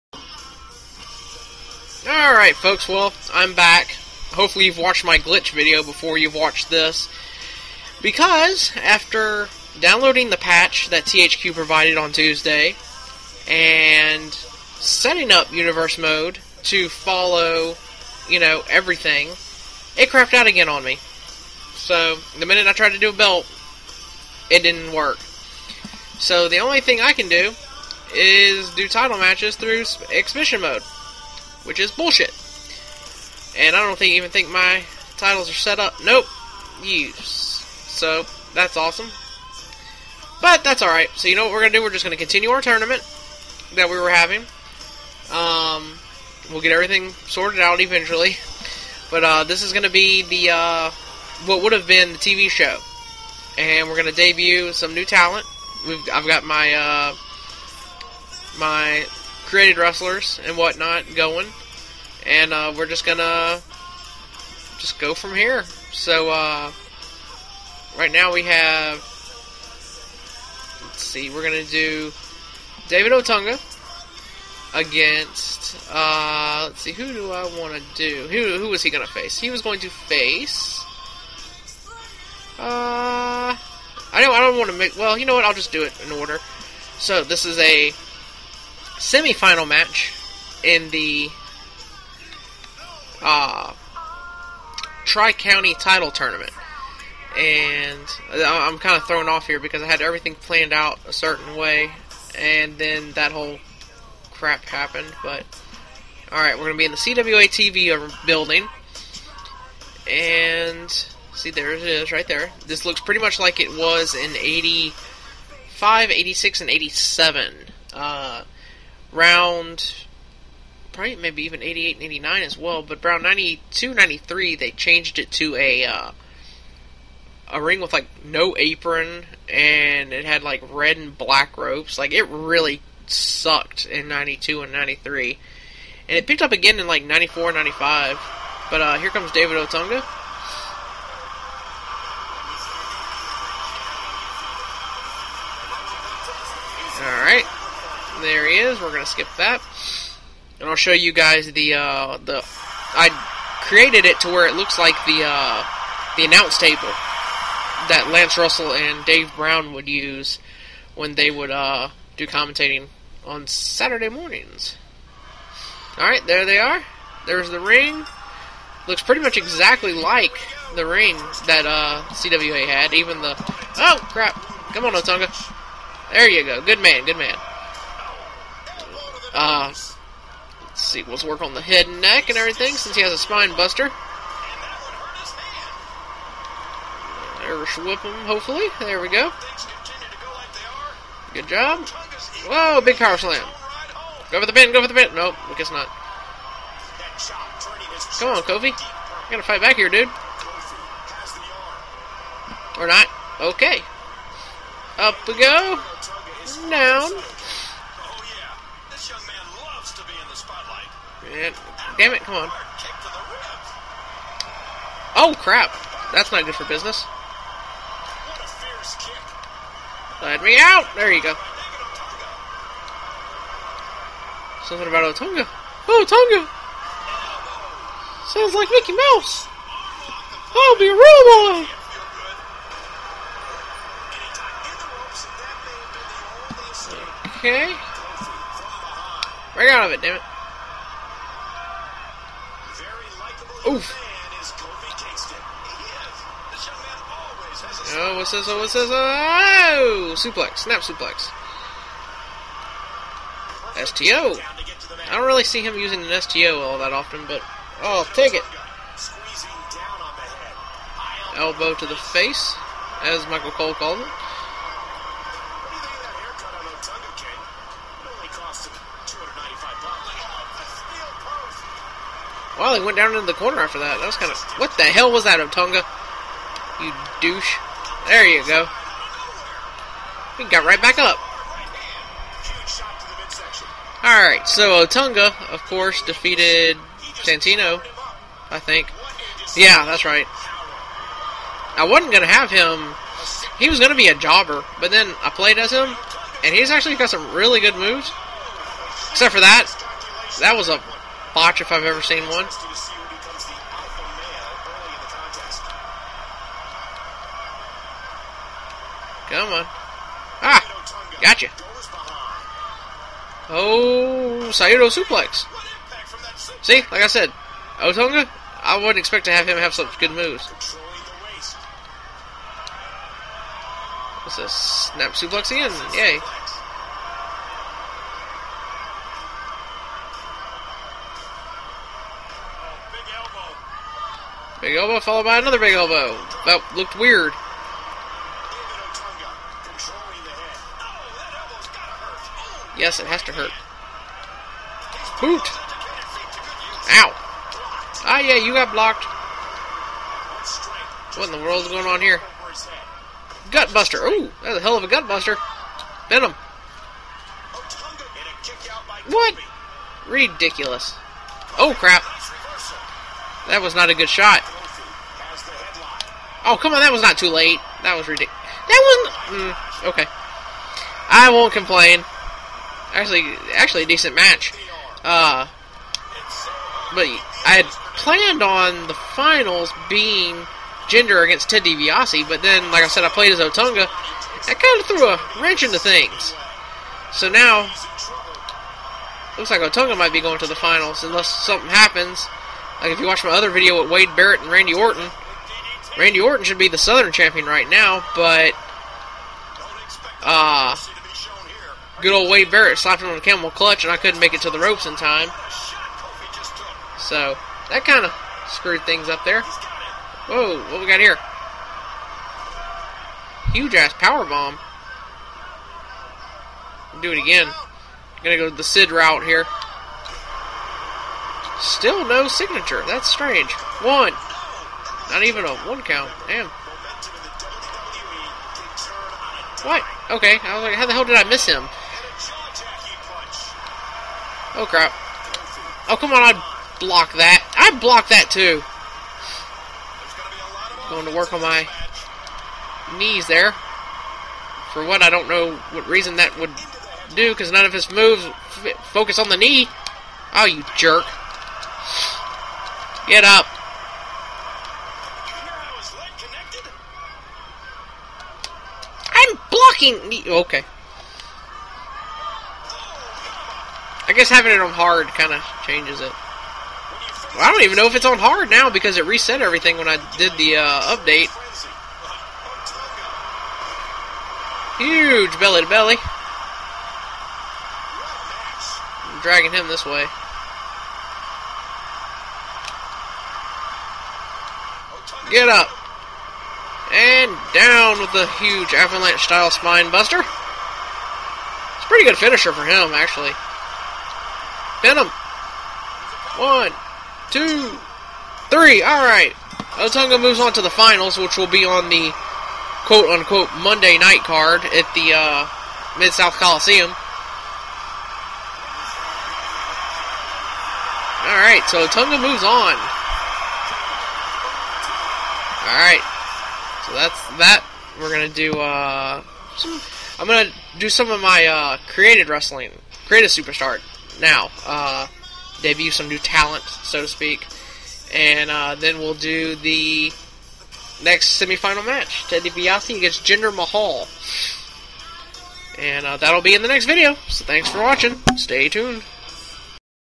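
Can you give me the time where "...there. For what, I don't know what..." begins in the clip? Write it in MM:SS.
07:23.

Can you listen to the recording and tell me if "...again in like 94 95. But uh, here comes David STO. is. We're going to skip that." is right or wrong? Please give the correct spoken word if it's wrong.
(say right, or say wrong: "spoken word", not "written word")
wrong: "Otunga", not "STO".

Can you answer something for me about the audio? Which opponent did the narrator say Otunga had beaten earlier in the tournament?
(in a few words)
Santino.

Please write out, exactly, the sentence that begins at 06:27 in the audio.
So now, looks like Otunga might be going to the finals unless something happens.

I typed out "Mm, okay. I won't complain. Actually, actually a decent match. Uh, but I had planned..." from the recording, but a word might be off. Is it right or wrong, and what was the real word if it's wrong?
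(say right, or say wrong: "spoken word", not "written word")
right.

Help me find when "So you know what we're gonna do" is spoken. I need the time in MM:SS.
00:41.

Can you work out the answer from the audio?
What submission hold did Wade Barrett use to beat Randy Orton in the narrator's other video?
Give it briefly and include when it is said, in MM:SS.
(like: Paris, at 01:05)
Camel clutch, at 06:43.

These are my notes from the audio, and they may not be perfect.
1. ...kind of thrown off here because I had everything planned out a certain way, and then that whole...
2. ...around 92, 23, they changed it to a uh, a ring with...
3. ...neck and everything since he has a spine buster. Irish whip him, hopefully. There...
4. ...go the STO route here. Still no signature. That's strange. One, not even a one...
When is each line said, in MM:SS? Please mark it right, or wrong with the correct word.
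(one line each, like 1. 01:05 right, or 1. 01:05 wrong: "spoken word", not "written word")
1. 01:38 right
2. 02:03 wrong: "93", not "23"
3. 03:02 right
4. 06:58 wrong: "Sid", not "STO".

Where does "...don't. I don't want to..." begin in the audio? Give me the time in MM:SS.
01:24.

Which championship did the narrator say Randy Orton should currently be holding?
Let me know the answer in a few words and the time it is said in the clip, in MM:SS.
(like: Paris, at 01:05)
Southern champion, at 06:36.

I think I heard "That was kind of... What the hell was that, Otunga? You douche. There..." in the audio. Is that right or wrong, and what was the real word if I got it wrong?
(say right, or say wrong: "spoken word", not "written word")
right.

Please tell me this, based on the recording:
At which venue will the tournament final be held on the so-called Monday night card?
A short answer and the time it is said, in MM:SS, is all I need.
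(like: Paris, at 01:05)
Mid-South Coliseum, at 08:25.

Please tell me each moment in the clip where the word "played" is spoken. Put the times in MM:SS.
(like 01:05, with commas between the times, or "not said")
04:55, 06:23.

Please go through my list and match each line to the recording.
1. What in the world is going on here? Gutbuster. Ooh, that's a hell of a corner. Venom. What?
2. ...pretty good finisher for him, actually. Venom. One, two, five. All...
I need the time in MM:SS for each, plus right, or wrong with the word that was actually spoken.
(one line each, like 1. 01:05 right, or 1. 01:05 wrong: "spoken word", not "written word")
1. 05:51 wrong: "gutbuster", not "corner"
2. 08:11 wrong: "three", not "five".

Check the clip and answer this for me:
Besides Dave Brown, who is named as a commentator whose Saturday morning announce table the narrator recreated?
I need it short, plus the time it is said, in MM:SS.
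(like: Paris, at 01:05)
Lance Russell, at 02:38.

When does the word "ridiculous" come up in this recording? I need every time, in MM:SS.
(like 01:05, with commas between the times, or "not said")
06:00, 06:08.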